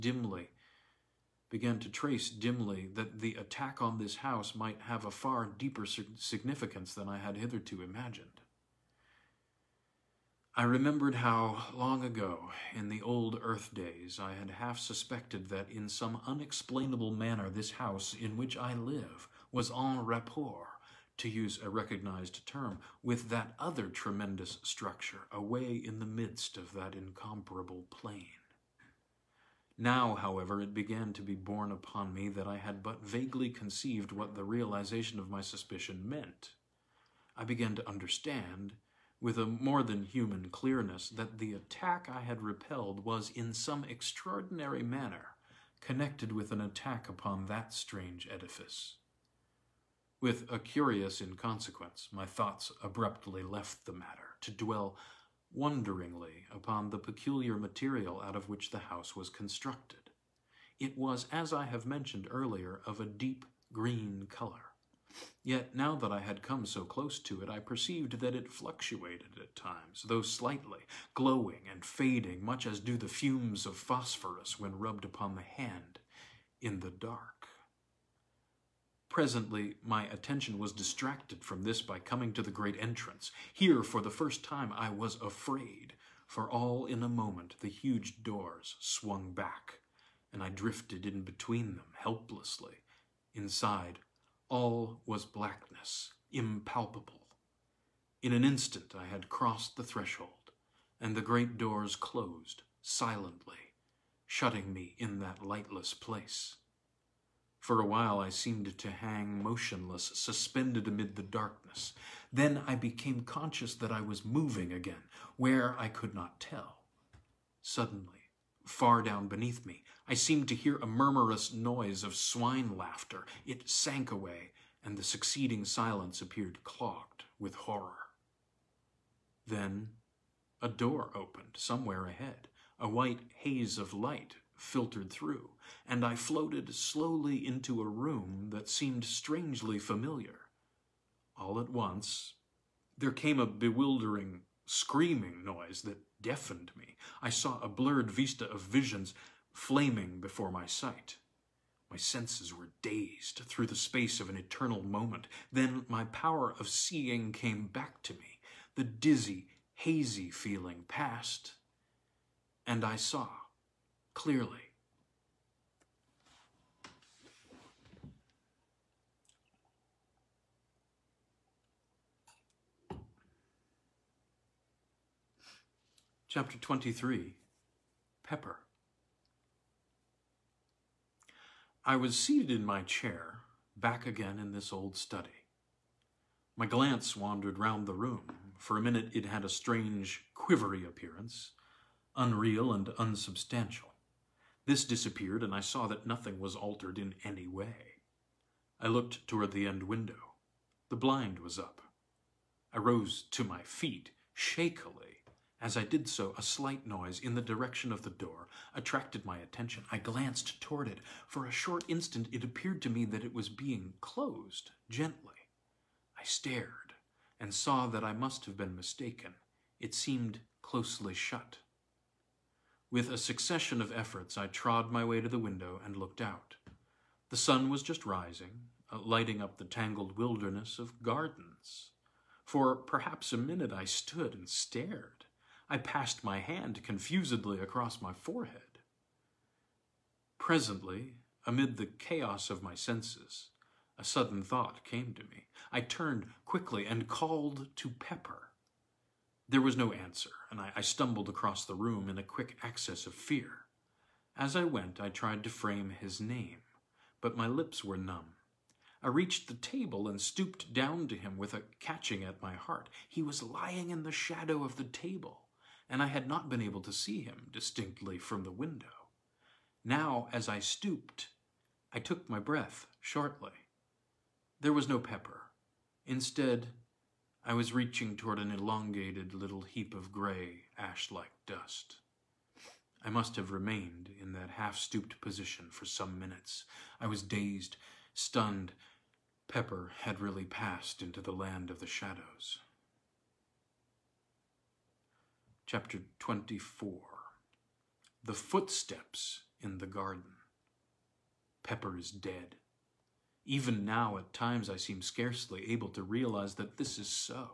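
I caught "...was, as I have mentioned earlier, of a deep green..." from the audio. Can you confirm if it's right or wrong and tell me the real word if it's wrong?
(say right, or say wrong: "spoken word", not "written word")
right.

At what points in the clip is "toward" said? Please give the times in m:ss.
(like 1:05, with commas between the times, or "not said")
3:19, 3:30, 4:38.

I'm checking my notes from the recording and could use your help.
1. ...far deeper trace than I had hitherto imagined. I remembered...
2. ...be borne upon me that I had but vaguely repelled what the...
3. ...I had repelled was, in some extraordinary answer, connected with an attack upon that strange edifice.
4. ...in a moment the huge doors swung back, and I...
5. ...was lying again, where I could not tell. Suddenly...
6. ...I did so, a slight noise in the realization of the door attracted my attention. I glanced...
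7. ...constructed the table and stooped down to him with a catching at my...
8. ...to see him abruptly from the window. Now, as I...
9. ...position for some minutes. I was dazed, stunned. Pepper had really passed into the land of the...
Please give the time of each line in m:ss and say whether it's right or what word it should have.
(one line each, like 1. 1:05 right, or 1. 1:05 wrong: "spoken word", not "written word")
1. 0:05 wrong: "significance", not "trace"
2. 0:31 wrong: "conceived", not "repelled"
3. 0:42 wrong: "manner", not "answer"
4. 1:26 right
5. 1:54 wrong: "moving", not "lying"
6. 3:25 wrong: "direction", not "realization"
7. 4:19 wrong: "reached", not "constructed"
8. 4:26 wrong: "distinctly", not "abruptly"
9. 4:45 right.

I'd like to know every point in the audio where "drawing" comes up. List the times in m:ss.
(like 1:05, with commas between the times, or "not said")
not said.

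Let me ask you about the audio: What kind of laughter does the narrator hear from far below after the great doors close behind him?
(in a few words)
Swine laughter.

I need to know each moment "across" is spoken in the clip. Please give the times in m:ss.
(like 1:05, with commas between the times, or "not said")
3:57, 4:11.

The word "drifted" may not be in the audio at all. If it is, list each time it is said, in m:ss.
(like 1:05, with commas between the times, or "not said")
1:30.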